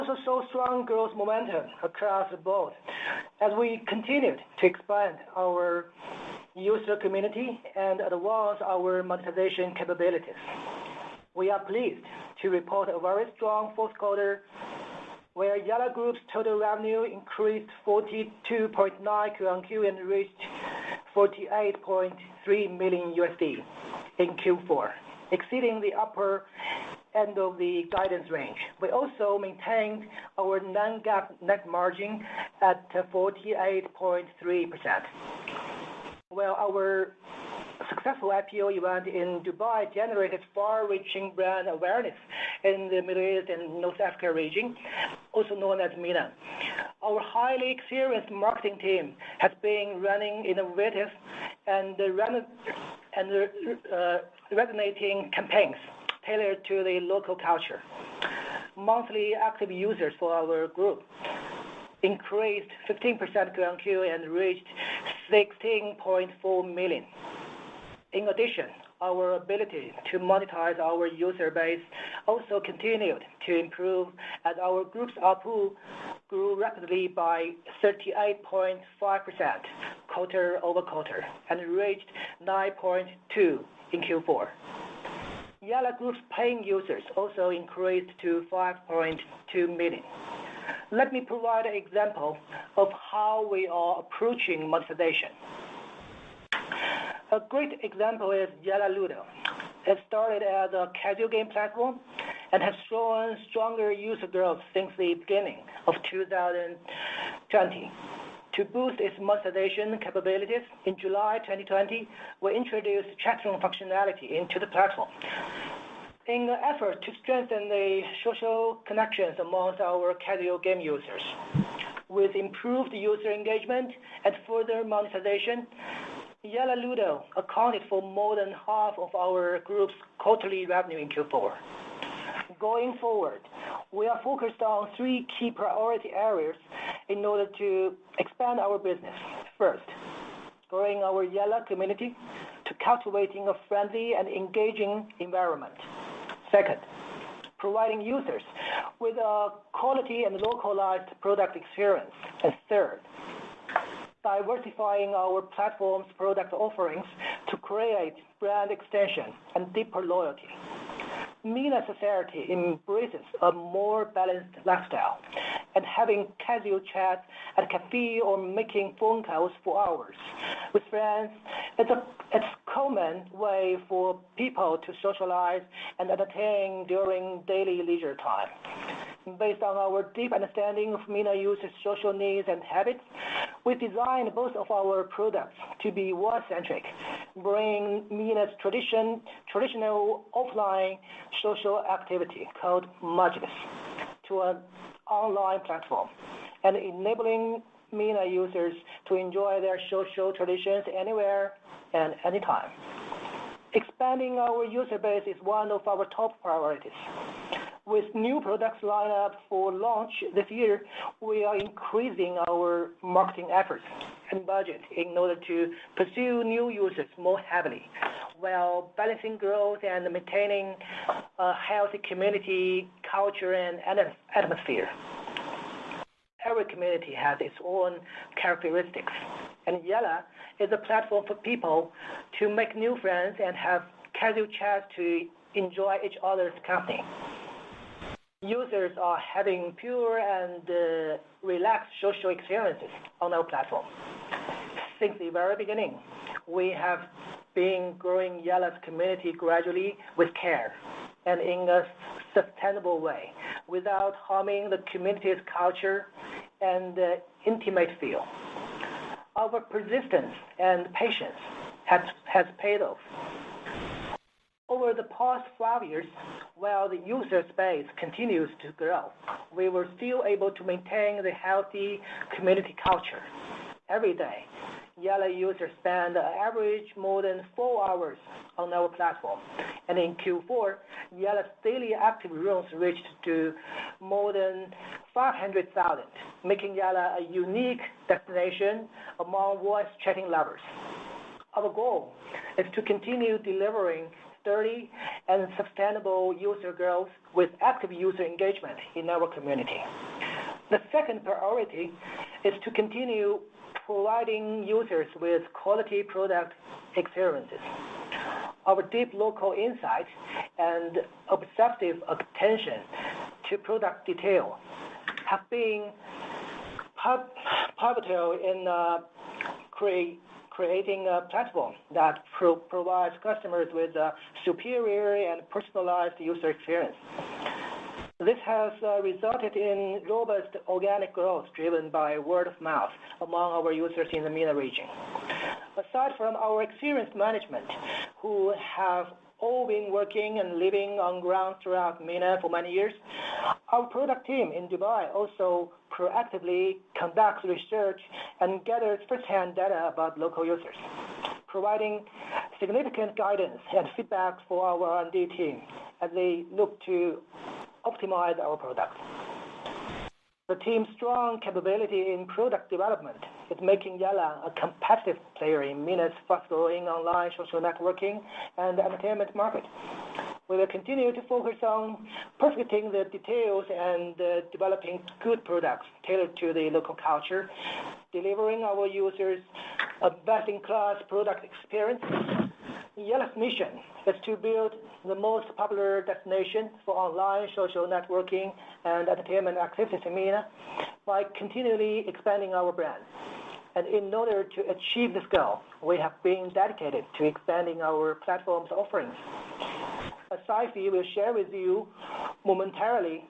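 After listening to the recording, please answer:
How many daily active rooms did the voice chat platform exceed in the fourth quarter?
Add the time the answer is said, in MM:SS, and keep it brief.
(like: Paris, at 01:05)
500,000, at 04:45.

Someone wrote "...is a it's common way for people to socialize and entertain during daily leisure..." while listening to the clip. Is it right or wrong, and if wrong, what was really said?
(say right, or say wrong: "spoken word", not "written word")
right.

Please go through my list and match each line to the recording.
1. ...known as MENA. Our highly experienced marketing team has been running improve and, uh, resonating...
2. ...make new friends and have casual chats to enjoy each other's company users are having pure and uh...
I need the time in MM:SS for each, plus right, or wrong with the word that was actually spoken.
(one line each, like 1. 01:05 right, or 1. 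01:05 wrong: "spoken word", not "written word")
1. 00:45 wrong: "innovative", not "improve"
2. 03:52 right.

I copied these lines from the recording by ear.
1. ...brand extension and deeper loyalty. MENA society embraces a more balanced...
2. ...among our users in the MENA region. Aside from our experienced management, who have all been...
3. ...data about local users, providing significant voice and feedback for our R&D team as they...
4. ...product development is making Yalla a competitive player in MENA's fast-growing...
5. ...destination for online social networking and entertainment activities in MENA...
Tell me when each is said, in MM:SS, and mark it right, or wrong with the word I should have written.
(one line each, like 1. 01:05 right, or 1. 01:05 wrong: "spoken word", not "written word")
1. 02:38 right
2. 05:33 right
3. 05:49 wrong: "guidance", not "voice"
4. 06:02 right
5. 06:26 right.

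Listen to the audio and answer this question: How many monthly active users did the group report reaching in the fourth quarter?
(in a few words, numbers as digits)
16.4 million.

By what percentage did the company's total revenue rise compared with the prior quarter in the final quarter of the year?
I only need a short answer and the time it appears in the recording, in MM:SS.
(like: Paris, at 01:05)
42.9%, at 00:17.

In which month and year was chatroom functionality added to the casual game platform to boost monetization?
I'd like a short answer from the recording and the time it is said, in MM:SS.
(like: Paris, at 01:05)
July 2020, at 01:50.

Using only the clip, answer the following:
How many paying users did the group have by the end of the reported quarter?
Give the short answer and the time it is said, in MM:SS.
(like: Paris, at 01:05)
5.2 million, at 01:28.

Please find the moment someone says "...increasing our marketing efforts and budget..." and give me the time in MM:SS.
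03:31.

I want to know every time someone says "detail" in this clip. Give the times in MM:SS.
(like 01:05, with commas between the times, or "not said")
05:14, 06:13.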